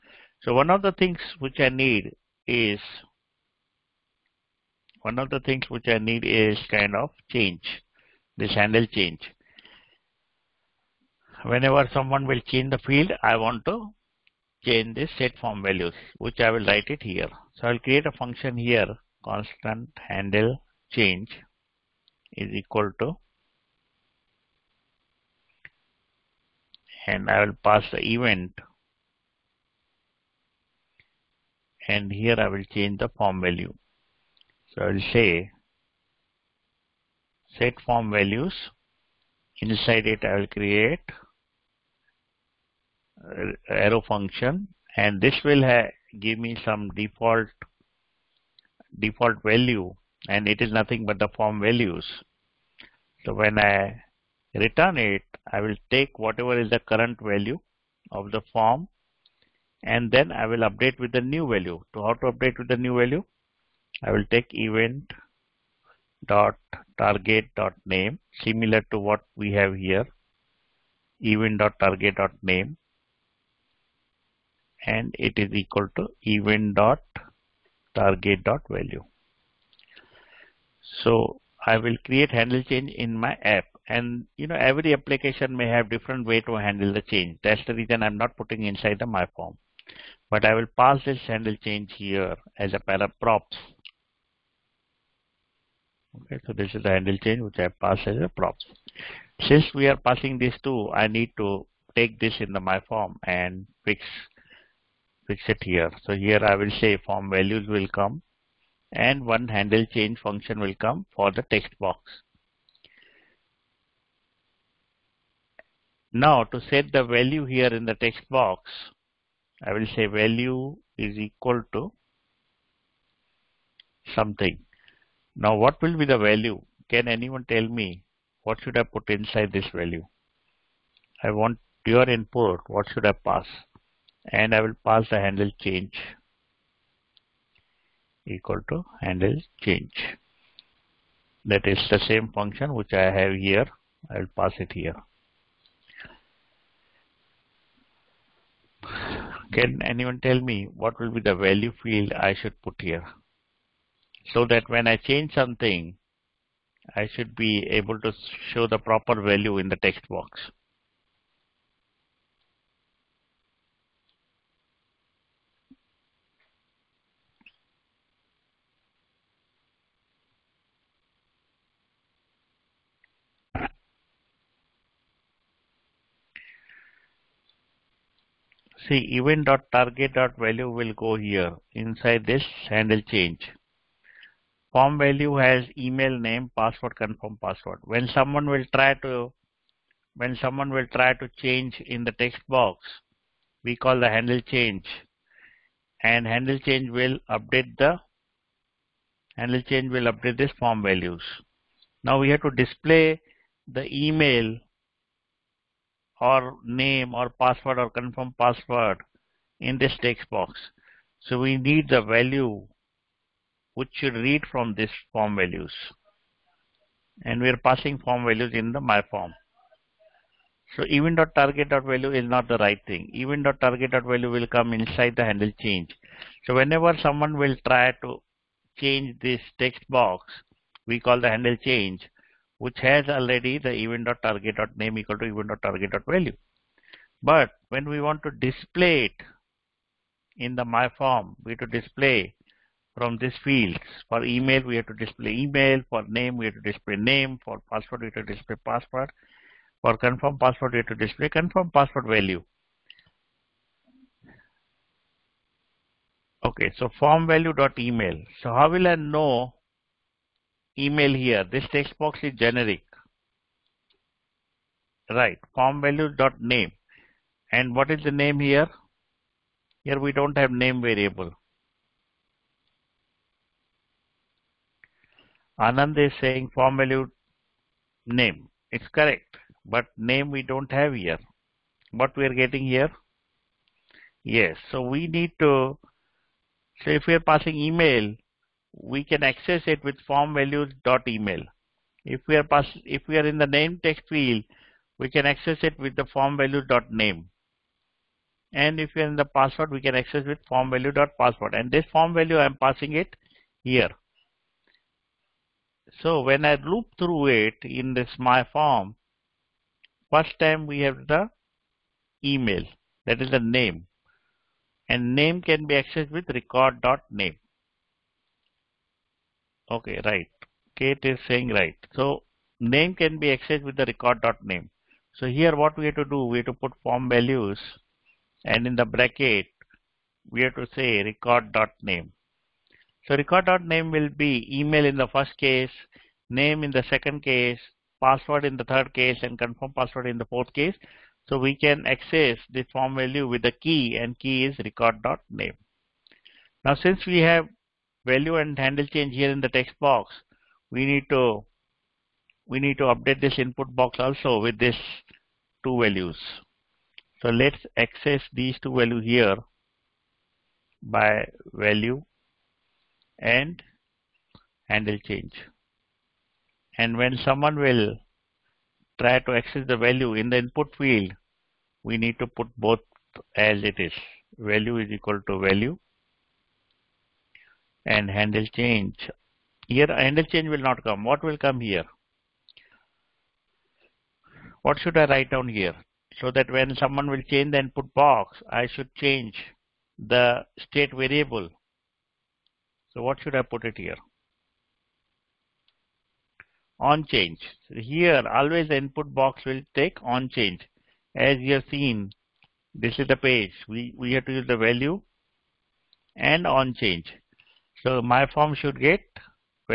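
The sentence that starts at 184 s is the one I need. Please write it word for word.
Form value has email name, password, confirm password.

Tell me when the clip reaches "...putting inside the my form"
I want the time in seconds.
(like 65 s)
88 s.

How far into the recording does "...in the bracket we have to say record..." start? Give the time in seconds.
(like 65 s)
328 s.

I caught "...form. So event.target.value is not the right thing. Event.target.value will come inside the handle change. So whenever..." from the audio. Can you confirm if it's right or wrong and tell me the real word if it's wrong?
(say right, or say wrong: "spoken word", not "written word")
right.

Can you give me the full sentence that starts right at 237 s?
But when we want to display it in the my form, we have to display from these fields.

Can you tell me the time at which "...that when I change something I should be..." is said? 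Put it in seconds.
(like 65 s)
154 s.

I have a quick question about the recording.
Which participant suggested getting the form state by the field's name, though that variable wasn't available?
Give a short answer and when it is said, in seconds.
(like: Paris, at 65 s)
Anand, at 275 s.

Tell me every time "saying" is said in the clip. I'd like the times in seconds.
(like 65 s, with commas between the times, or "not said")
276 s, 321 s.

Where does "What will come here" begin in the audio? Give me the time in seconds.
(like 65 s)
381 s.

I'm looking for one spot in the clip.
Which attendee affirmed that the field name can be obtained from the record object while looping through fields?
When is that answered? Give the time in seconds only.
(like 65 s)
320 s.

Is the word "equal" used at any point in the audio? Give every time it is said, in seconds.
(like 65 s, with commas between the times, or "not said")
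22 s, 75 s, 121 s, 138 s, 234 s, 374 s.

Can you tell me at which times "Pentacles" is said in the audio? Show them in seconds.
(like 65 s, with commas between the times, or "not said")
not said.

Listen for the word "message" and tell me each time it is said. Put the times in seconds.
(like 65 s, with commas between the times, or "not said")
not said.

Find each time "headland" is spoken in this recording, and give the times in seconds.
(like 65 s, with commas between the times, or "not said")
not said.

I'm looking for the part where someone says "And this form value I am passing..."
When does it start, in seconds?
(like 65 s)
301 s.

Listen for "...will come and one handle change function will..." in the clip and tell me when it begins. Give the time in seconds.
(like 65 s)
107 s.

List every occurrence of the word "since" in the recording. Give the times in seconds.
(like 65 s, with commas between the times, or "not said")
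99 s, 346 s.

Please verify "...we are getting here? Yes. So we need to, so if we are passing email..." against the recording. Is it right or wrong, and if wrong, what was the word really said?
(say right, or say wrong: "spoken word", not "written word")
right.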